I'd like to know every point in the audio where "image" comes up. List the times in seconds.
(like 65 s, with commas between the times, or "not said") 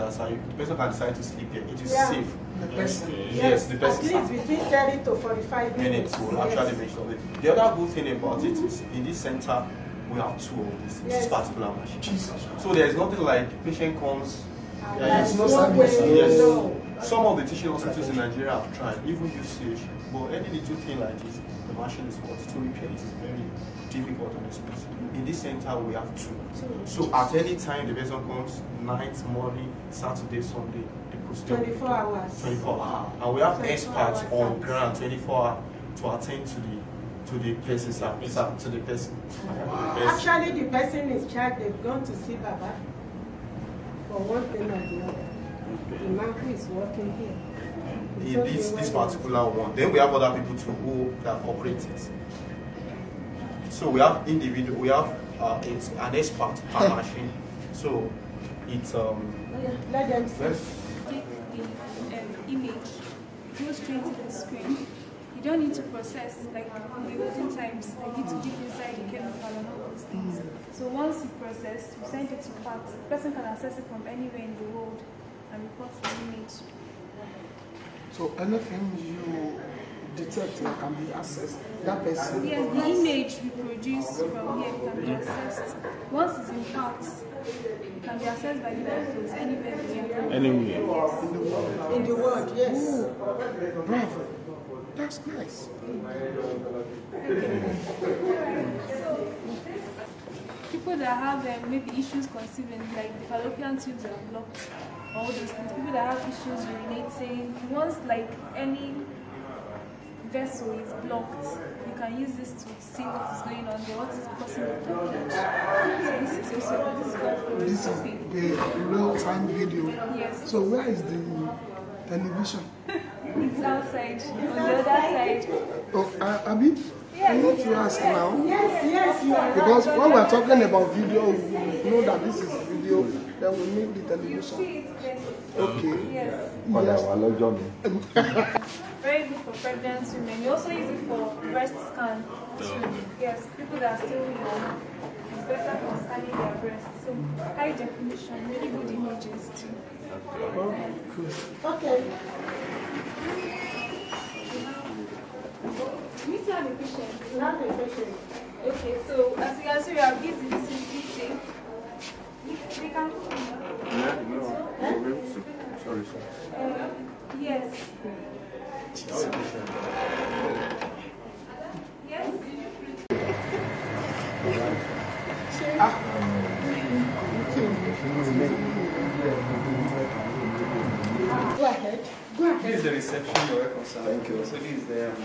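62 s, 76 s, 82 s, 148 s.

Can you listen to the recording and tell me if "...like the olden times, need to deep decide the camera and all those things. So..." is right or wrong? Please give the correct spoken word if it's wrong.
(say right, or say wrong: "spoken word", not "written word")
wrong: "inside", not "decide".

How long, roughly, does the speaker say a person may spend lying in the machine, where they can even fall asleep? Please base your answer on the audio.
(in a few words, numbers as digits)
30 to 45 minutes.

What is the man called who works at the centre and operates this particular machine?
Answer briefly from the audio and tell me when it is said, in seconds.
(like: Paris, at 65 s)
Baba, at 42 s.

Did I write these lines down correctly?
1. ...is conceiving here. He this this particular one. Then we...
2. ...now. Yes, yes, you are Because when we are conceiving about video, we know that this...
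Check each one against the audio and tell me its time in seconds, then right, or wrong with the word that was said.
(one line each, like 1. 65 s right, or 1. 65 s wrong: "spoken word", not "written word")
1. 46 s wrong: "working", not "conceiving"
2. 128 s wrong: "talking", not "conceiving".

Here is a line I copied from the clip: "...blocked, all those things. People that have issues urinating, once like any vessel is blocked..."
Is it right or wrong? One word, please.
right.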